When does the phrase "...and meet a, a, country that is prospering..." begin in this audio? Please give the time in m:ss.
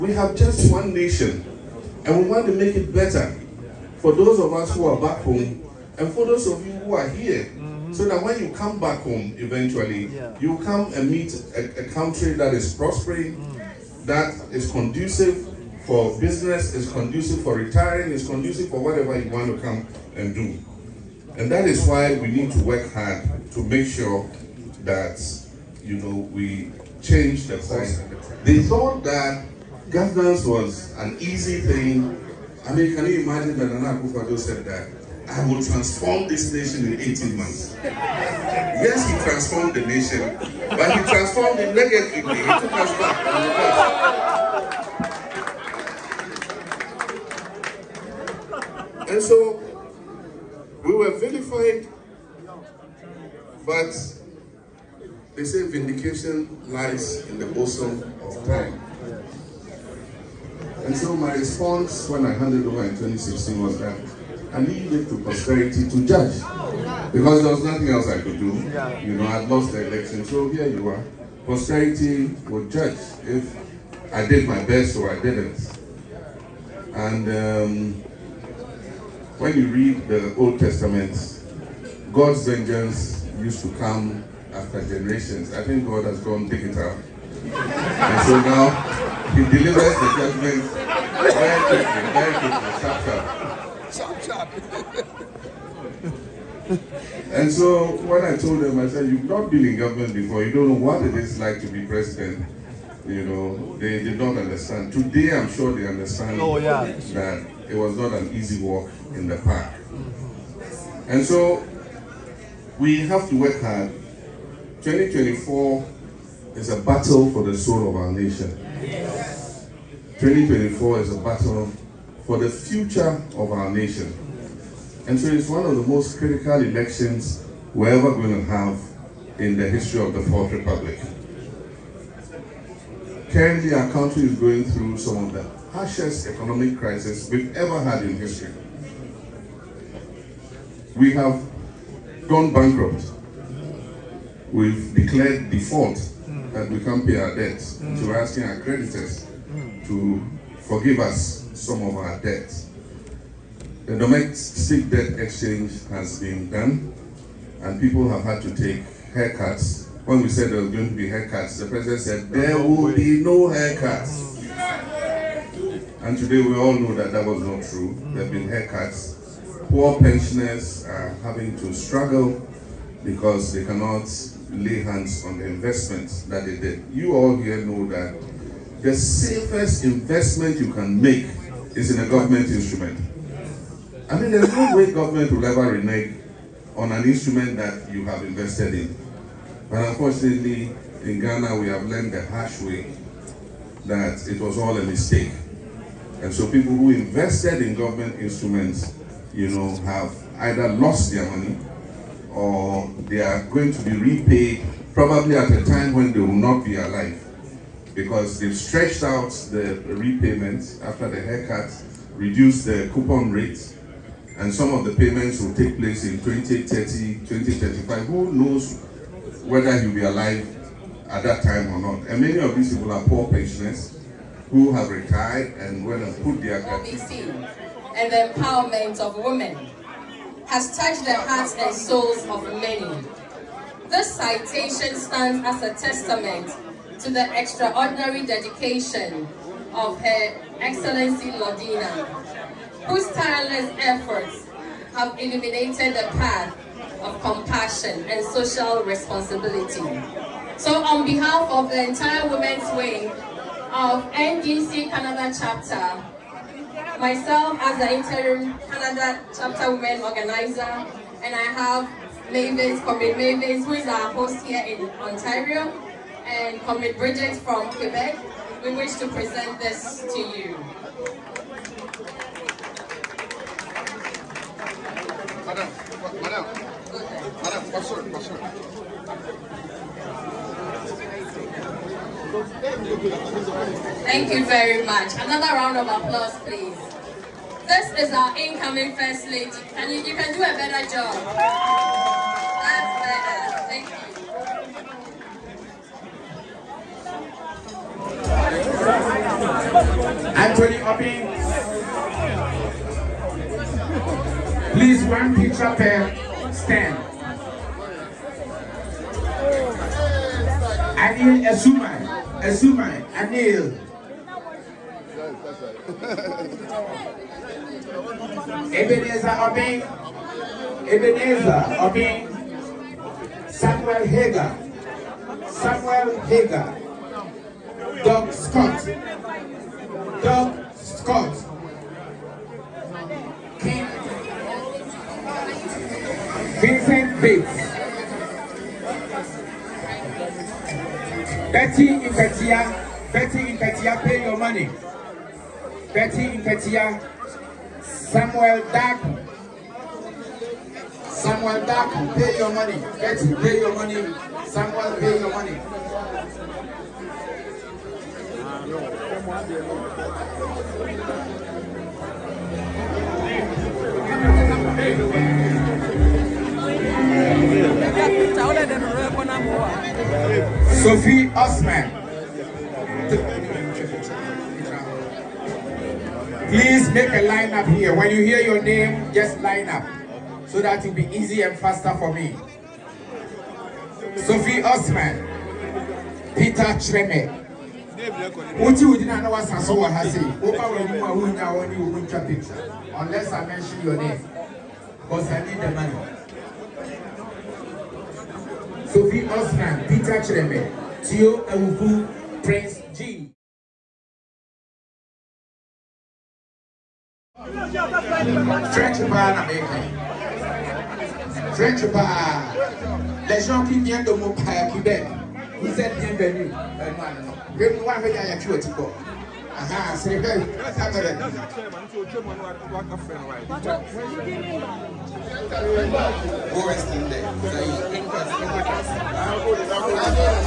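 0:10.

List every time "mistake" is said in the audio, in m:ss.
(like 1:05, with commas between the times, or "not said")
3:14.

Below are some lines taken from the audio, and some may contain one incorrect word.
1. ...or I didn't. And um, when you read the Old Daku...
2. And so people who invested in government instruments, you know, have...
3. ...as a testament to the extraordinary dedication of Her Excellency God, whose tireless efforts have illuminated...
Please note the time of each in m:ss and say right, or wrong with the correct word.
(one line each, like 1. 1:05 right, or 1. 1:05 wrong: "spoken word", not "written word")
1. 1:14 wrong: "Testament", not "Daku"
2. 3:16 right
3. 3:55 wrong: "Lordina", not "God".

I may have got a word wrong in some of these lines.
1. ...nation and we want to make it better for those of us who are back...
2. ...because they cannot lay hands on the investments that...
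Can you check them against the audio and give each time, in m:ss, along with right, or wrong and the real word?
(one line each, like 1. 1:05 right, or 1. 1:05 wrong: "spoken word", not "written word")
1. 0:00 right
2. 2:53 right.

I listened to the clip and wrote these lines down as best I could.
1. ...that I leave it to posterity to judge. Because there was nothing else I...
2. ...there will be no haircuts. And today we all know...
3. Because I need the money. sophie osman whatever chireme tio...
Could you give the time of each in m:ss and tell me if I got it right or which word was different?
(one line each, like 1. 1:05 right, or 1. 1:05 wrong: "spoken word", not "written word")
1. 1:03 right
2. 2:42 right
3. 6:35 wrong: "peter", not "whatever".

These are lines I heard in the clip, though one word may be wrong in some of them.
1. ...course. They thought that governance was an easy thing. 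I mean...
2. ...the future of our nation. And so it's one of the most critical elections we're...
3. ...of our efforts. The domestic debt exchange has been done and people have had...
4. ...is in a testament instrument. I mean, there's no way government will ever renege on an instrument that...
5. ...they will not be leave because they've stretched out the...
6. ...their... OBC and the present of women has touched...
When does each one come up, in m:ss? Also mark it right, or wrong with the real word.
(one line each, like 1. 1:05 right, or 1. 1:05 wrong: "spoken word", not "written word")
1. 0:27 right
2. 2:02 right
3. 2:31 wrong: "debts", not "efforts"
4. 3:01 wrong: "government", not "testament"
5. 3:26 wrong: "alive", not "leave"
6. 3:46 wrong: "empowerment", not "present".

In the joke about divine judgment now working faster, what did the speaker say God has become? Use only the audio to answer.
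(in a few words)
digital.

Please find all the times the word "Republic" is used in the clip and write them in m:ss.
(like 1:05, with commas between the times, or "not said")
2:10.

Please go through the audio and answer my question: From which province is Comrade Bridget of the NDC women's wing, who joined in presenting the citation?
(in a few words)
Quebec.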